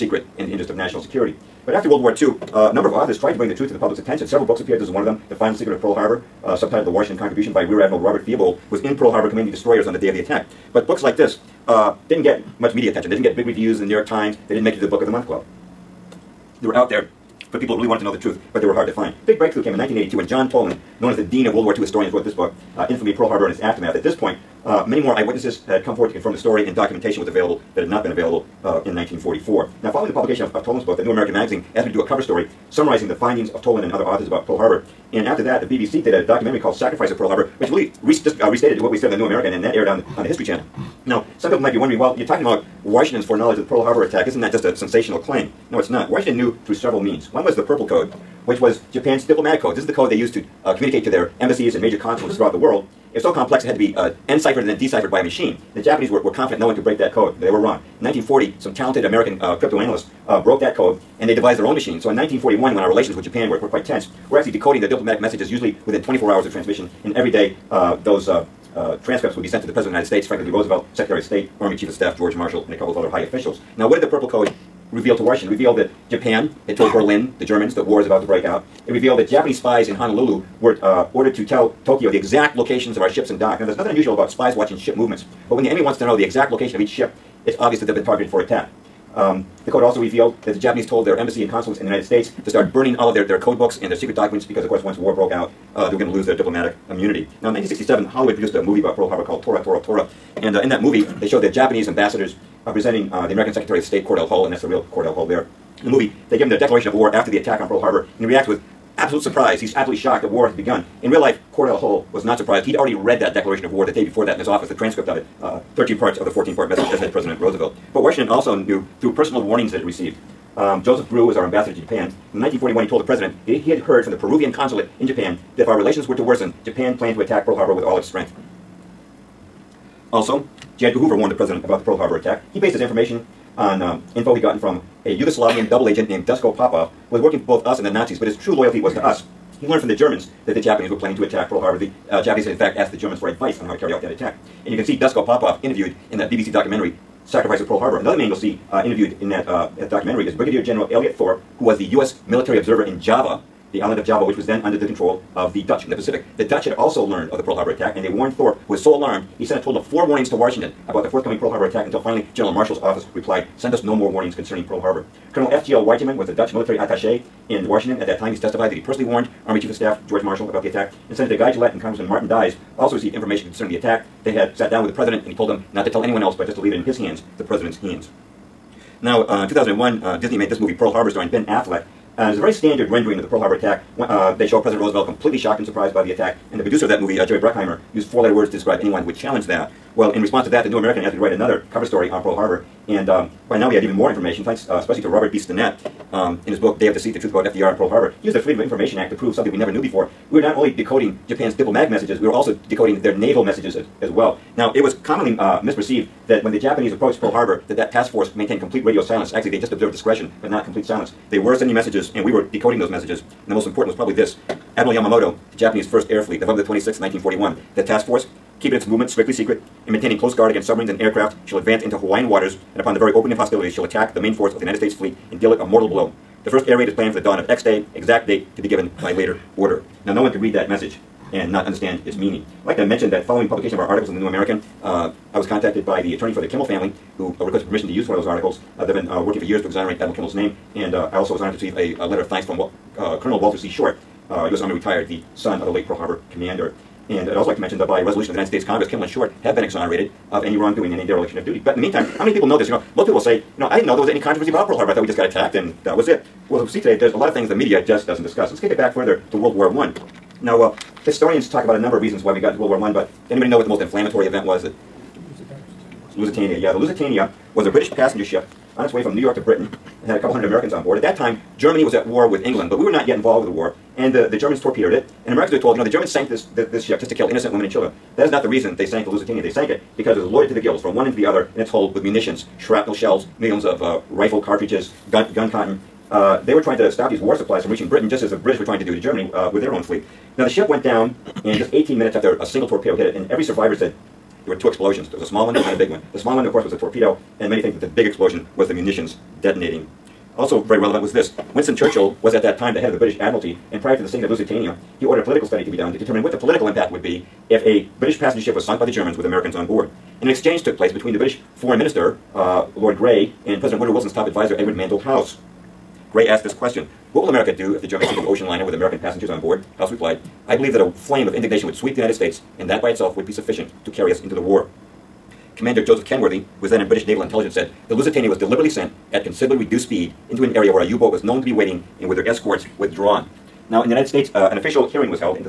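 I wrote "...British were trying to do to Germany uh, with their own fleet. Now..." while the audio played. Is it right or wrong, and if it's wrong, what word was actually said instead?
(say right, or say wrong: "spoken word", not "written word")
right.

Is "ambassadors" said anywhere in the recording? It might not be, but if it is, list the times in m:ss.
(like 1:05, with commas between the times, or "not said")
1:41, 2:01.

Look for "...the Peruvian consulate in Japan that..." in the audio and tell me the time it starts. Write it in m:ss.
2:04.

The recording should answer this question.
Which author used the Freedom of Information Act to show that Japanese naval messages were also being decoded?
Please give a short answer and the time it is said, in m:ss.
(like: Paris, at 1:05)
Robert B. Stinnett, at 3:15.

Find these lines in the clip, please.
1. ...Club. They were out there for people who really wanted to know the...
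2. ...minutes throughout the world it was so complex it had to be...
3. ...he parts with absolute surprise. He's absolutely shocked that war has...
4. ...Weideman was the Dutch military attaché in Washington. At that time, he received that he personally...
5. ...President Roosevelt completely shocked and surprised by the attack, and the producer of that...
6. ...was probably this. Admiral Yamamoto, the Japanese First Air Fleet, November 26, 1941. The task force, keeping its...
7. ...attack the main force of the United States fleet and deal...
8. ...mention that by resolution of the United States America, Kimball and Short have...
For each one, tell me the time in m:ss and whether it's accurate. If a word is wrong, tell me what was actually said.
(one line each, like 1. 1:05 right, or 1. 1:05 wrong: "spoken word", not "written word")
1. 0:15 right
2. 0:51 wrong: "consulates", not "minutes"
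3. 1:48 wrong: "reacts", not "parts"
4. 2:45 wrong: "testified", not "received"
5. 3:04 right
6. 3:33 right
7. 3:43 right
8. 4:07 wrong: "Congress", not "America".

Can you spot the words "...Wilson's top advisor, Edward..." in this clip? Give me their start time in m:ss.
5:13.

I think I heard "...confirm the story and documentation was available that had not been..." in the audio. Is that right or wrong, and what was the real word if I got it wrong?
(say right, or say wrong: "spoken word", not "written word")
right.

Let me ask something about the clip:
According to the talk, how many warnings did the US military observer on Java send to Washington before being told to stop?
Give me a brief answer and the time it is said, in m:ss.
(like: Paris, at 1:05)
4, at 2:39.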